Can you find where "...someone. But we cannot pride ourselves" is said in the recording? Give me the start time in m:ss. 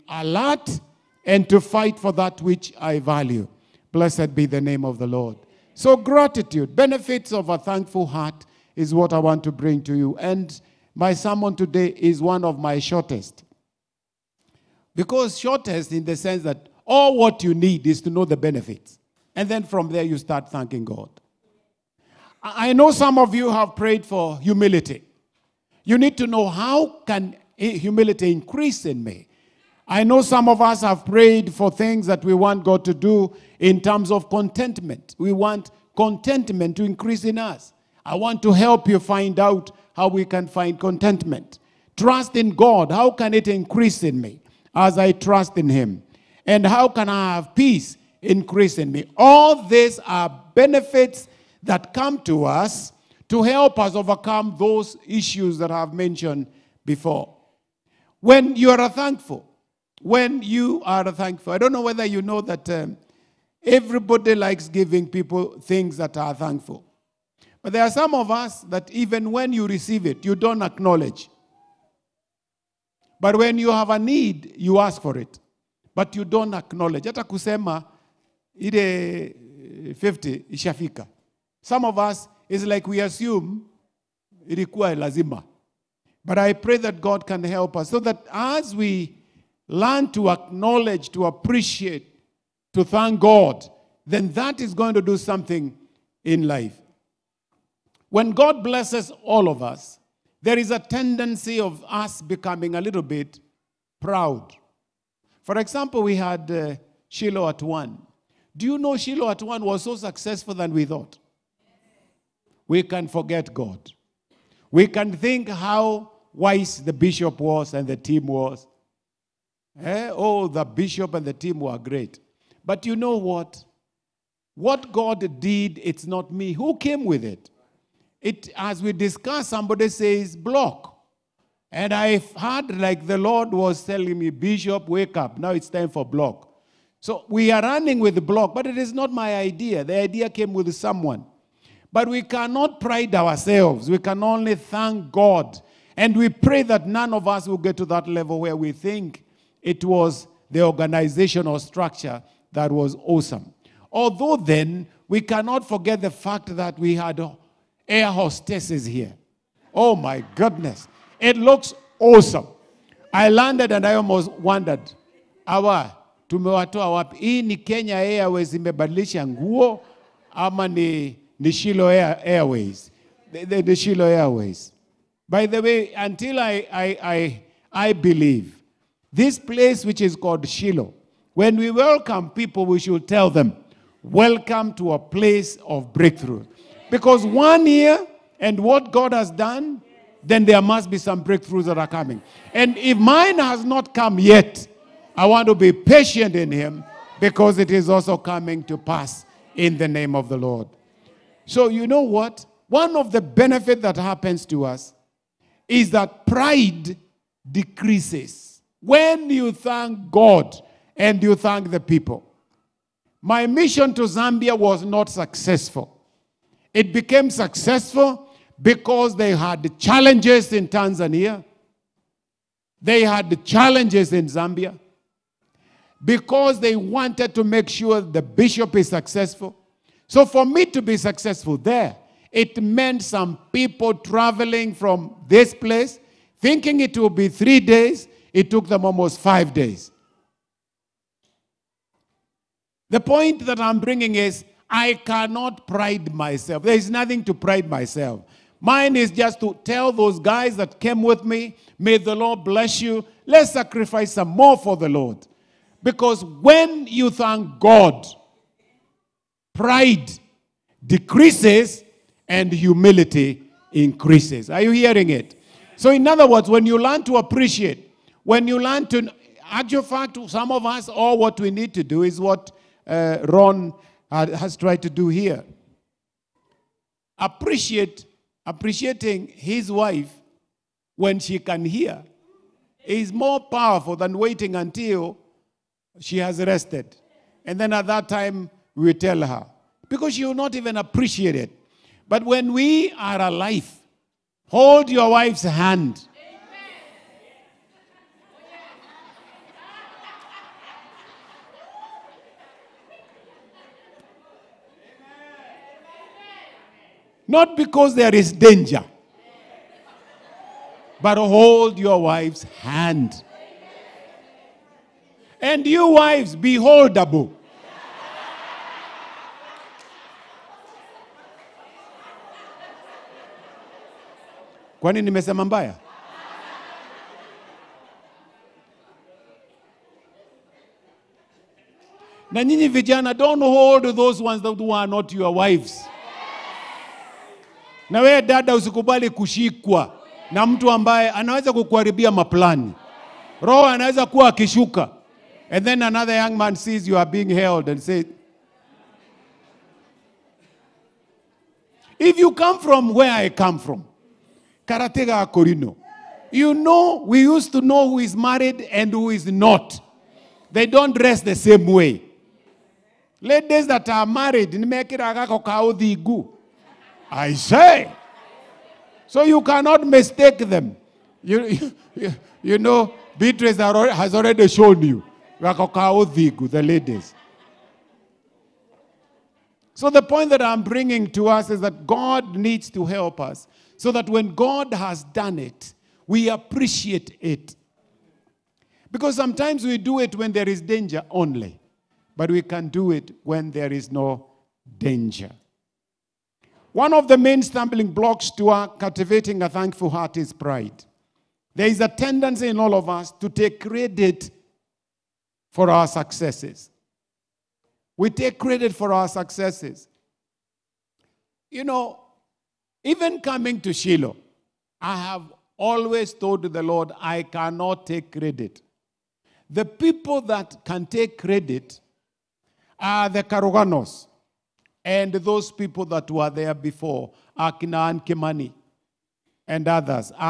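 2:20.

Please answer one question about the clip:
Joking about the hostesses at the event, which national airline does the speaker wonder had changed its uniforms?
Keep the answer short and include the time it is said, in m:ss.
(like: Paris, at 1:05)
Kenya Airways, at 2:47.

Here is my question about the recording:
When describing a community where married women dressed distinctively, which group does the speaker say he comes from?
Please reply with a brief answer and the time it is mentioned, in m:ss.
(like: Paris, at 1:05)
Karatega Akorino, at 5:54.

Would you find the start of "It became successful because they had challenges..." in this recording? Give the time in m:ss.
3:36.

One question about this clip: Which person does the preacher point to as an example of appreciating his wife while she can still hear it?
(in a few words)
Ron.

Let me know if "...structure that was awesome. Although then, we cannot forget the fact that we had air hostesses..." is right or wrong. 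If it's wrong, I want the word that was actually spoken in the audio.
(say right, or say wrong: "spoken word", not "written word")
right.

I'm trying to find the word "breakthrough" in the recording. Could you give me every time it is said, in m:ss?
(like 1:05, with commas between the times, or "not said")
3:05, 3:11.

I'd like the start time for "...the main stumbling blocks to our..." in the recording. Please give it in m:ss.
6:37.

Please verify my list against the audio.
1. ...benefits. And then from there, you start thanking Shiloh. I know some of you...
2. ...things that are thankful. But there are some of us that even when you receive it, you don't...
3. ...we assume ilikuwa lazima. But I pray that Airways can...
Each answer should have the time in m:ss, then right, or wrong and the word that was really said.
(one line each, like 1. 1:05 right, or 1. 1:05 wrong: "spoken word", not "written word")
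1. 0:18 wrong: "God", not "Shiloh"
2. 1:05 right
3. 1:22 wrong: "God", not "Airways".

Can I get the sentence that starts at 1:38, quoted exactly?
When God blesses all of us, there is a tendency of us becoming a little bit proud.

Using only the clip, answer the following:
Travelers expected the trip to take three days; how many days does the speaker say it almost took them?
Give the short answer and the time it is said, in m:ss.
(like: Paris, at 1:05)
5, at 3:59.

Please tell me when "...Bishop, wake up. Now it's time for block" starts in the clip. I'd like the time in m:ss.
2:14.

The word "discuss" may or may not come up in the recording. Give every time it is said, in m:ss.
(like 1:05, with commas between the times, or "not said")
2:08.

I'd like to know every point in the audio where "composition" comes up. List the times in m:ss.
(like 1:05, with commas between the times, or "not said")
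not said.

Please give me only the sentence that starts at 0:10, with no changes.
And my sermon today is one of my shortest.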